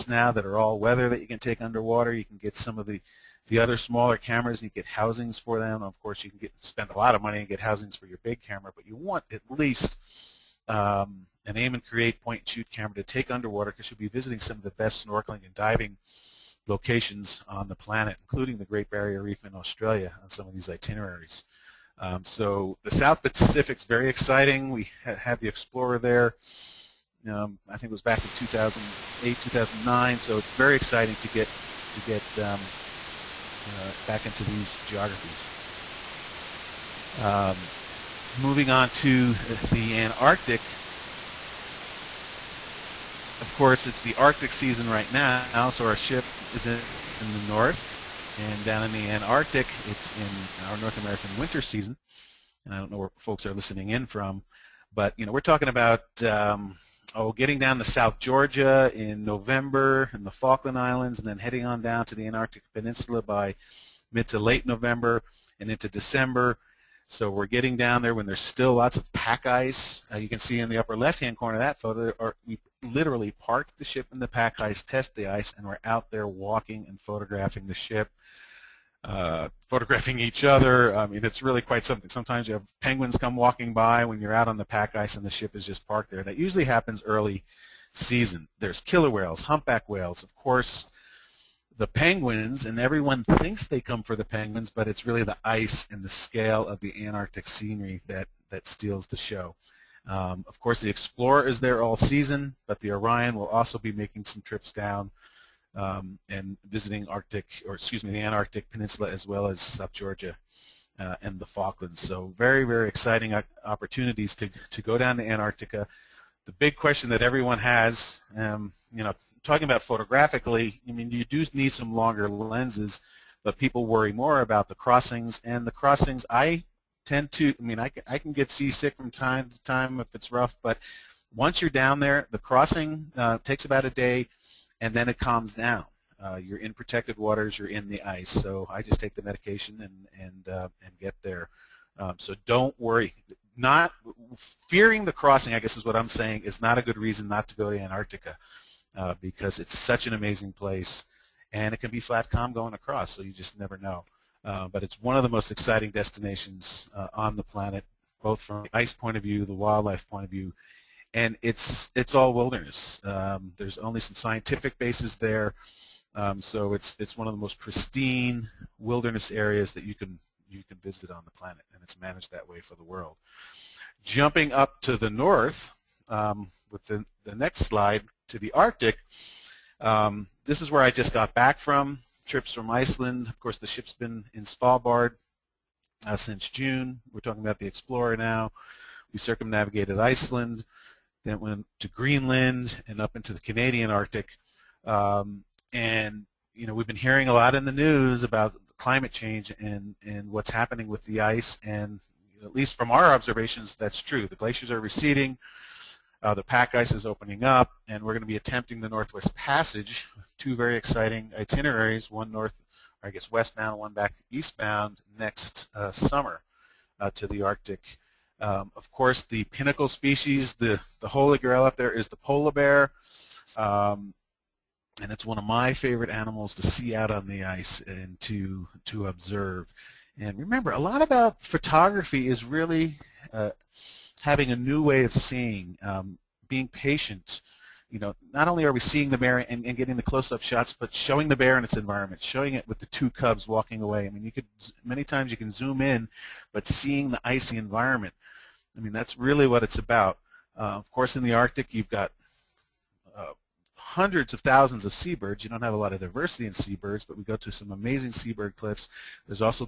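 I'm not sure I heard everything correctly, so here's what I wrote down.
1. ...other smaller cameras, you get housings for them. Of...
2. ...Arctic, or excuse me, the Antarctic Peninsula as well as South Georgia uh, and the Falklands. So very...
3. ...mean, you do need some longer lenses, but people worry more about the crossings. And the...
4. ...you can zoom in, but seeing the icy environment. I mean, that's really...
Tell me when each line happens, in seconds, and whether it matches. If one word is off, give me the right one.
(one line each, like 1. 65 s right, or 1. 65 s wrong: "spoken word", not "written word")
1. 3 s right
2. 107 s right
3. 120 s right
4. 245 s right.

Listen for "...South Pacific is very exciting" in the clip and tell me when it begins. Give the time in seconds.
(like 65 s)
22 s.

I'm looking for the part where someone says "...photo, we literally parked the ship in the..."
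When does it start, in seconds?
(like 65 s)
71 s.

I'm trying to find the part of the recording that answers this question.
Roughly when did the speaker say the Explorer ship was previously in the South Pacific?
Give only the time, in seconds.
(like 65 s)
28 s.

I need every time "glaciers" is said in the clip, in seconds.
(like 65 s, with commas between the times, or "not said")
204 s.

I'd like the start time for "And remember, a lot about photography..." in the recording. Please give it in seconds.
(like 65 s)
230 s.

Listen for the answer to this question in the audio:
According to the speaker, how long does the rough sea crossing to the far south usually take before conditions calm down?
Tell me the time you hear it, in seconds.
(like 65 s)
133 s.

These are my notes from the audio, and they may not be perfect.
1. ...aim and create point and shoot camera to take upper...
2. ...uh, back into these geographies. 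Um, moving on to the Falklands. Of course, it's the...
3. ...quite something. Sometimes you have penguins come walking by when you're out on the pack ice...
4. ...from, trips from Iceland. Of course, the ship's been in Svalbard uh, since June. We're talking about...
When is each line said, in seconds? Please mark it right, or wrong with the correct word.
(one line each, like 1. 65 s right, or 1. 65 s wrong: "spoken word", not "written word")
1. 11 s wrong: "underwater", not "upper"
2. 33 s wrong: "Antarctic", not "Falklands"
3. 81 s right
4. 181 s right.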